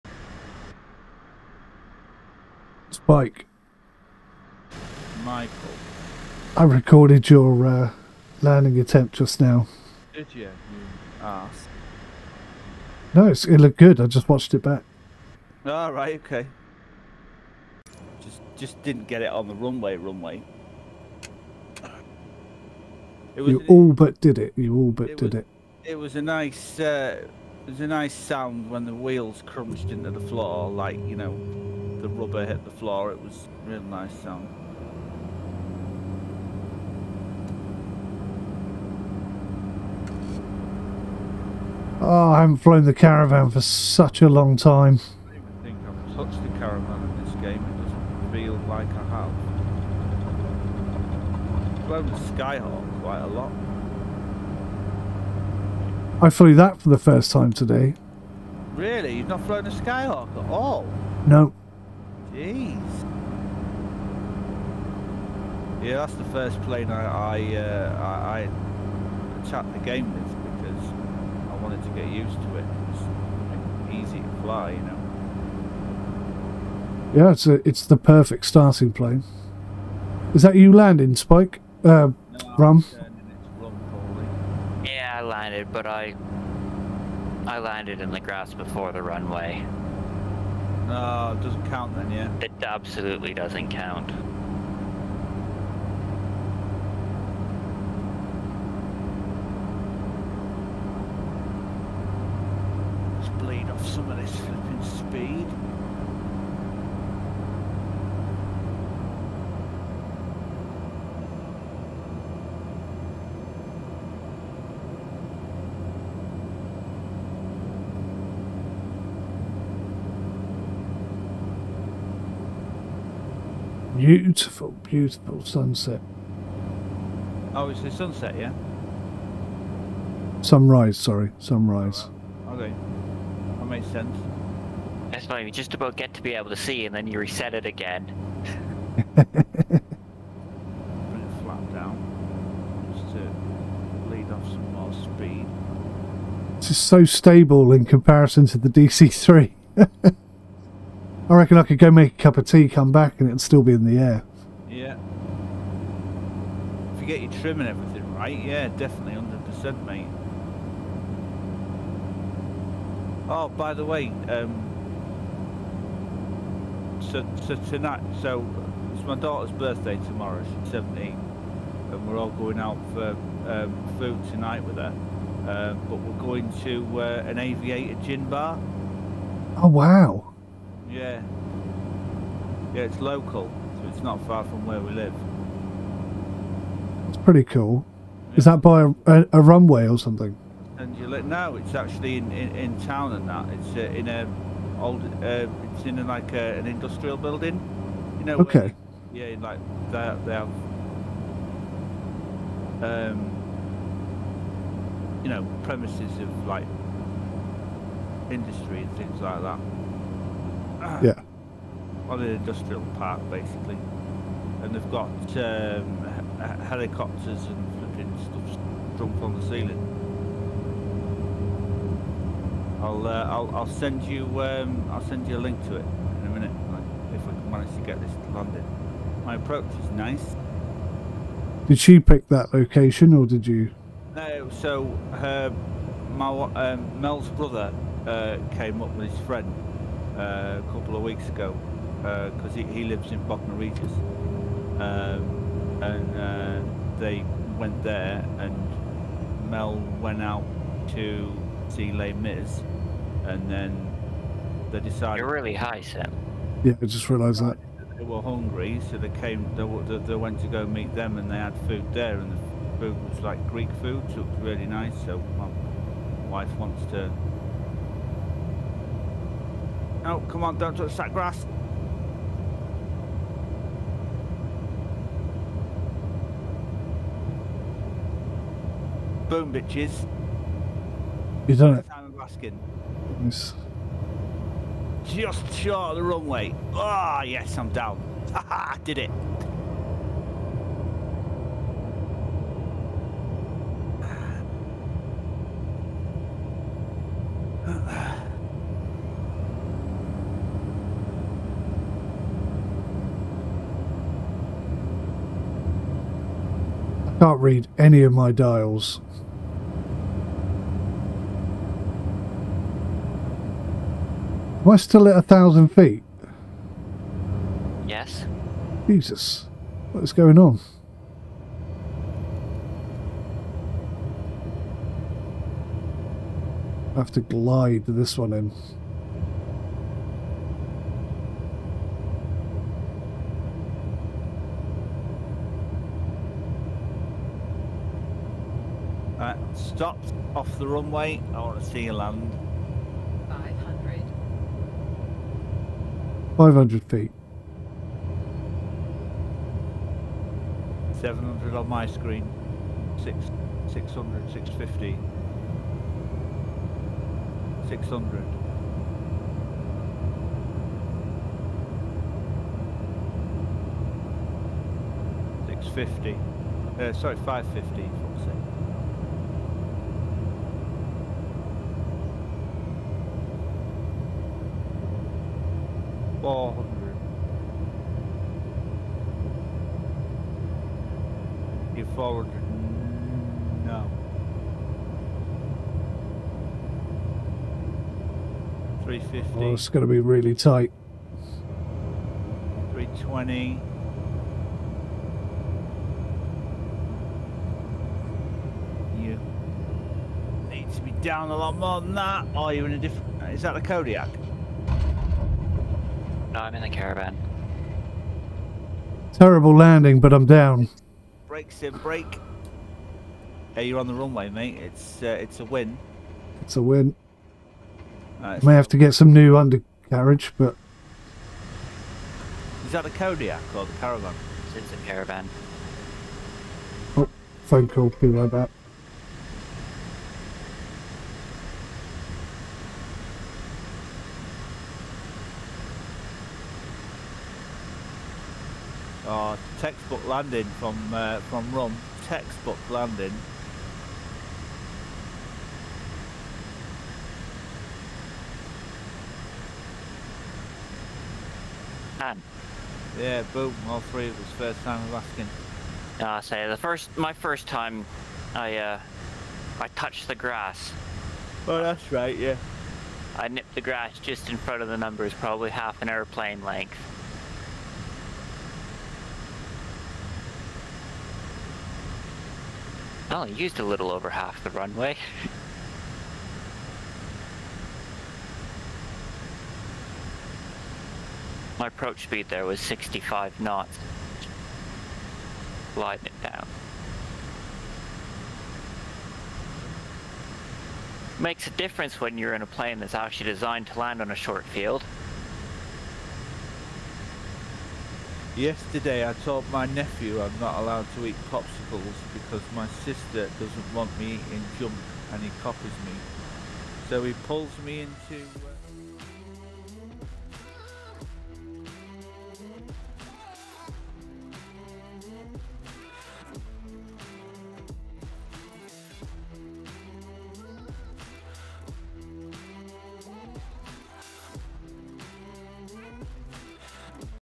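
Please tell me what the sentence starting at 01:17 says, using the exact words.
Yeah, it's a, it's the perfect starting plane.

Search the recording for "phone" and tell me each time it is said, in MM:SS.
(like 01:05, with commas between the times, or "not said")
07:07.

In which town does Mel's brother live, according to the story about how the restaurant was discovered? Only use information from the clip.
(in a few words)
Bognor Regis.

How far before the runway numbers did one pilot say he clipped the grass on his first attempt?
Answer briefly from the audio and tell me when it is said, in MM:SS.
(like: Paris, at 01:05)
Half an airplane length, at 07:45.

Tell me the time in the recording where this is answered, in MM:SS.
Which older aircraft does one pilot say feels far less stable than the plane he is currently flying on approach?
02:28.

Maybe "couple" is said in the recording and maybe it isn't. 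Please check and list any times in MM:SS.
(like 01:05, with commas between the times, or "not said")
04:00.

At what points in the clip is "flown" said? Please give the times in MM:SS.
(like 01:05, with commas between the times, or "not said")
00:42, 00:51, 00:59.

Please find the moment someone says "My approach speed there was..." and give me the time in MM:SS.
08:01.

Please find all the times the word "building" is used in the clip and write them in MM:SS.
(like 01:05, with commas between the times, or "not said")
03:17.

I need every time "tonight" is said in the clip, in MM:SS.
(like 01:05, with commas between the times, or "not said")
02:47, 02:54.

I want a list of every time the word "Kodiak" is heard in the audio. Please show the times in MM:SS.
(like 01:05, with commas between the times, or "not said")
06:43, 07:02.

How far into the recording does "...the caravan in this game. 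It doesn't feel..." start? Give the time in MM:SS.
00:46.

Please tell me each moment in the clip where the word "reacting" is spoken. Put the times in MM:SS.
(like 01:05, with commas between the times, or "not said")
not said.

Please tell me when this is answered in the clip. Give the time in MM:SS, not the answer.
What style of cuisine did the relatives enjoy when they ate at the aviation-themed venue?
04:23.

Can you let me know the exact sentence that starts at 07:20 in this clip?
landing from uh, from Rum, textbook landing.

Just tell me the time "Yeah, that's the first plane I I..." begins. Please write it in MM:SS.
01:05.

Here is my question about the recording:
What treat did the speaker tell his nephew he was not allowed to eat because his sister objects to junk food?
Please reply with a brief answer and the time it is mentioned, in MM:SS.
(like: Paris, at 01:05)
Popsicles, at 08:21.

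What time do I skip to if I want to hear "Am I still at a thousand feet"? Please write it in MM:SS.
05:14.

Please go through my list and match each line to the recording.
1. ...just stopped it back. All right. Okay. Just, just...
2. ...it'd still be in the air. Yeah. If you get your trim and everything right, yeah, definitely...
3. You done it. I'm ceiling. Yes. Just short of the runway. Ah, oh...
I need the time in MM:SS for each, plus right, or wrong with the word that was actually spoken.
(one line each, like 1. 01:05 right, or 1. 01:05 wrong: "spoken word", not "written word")
1. 00:14 wrong: "watched", not "stopped"
2. 02:33 right
3. 04:41 wrong: "asking", not "ceiling".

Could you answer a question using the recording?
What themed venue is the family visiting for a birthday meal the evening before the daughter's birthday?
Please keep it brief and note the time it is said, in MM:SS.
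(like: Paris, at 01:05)
Aviator gin bar, at 02:57.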